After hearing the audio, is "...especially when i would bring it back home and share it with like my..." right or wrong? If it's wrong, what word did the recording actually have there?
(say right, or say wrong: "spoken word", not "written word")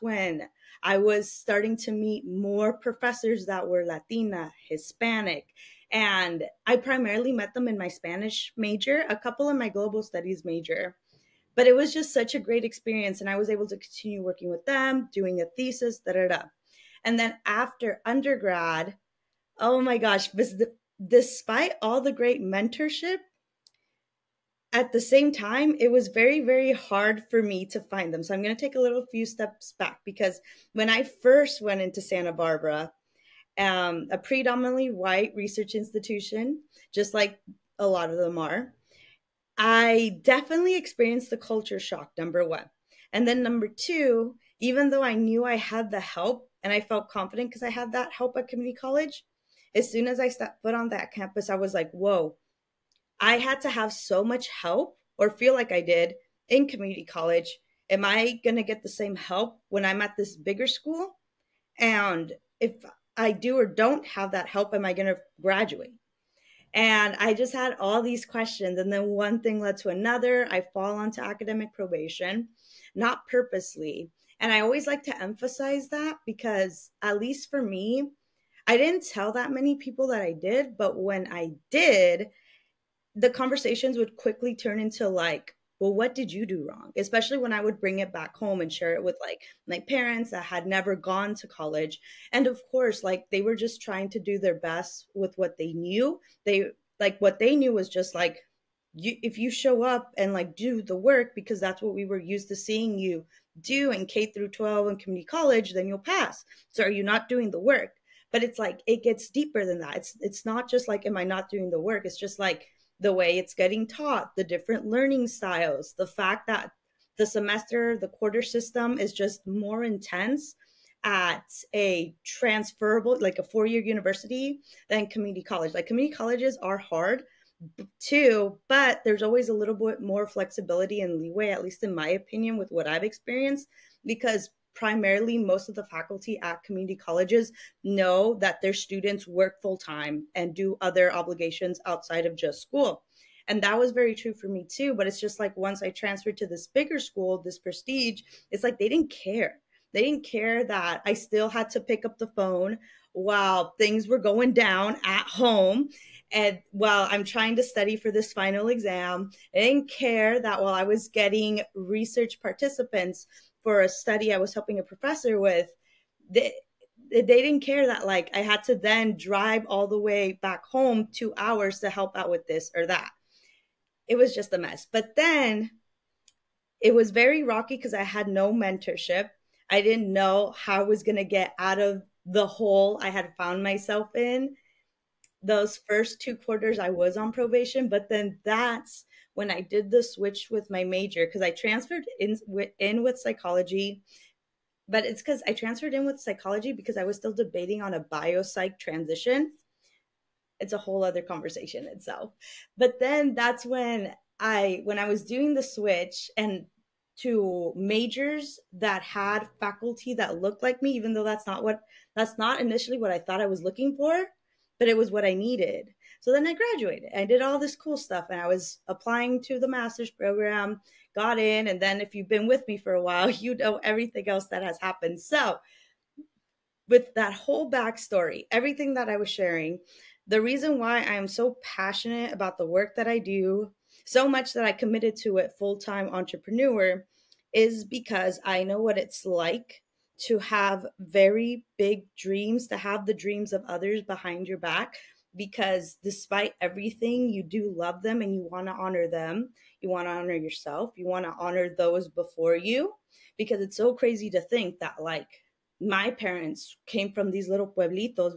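right.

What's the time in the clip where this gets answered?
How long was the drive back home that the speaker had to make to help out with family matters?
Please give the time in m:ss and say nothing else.
2:51.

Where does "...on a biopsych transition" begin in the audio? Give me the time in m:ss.
3:17.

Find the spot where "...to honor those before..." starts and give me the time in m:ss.
4:11.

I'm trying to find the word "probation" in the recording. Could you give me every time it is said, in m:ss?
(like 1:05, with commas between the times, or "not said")
1:11, 3:07.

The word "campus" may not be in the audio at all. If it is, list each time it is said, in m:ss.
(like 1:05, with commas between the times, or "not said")
0:51.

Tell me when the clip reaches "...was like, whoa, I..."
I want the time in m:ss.
0:51.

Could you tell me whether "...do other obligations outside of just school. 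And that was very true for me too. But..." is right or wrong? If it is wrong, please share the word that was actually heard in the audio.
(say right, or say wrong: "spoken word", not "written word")
right.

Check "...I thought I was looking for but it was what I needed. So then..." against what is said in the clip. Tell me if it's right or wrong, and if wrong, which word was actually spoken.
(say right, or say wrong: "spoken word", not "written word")
right.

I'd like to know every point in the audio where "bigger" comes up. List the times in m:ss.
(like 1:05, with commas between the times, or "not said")
1:00, 2:26.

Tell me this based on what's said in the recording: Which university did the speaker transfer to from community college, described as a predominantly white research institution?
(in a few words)
Santa Barbara.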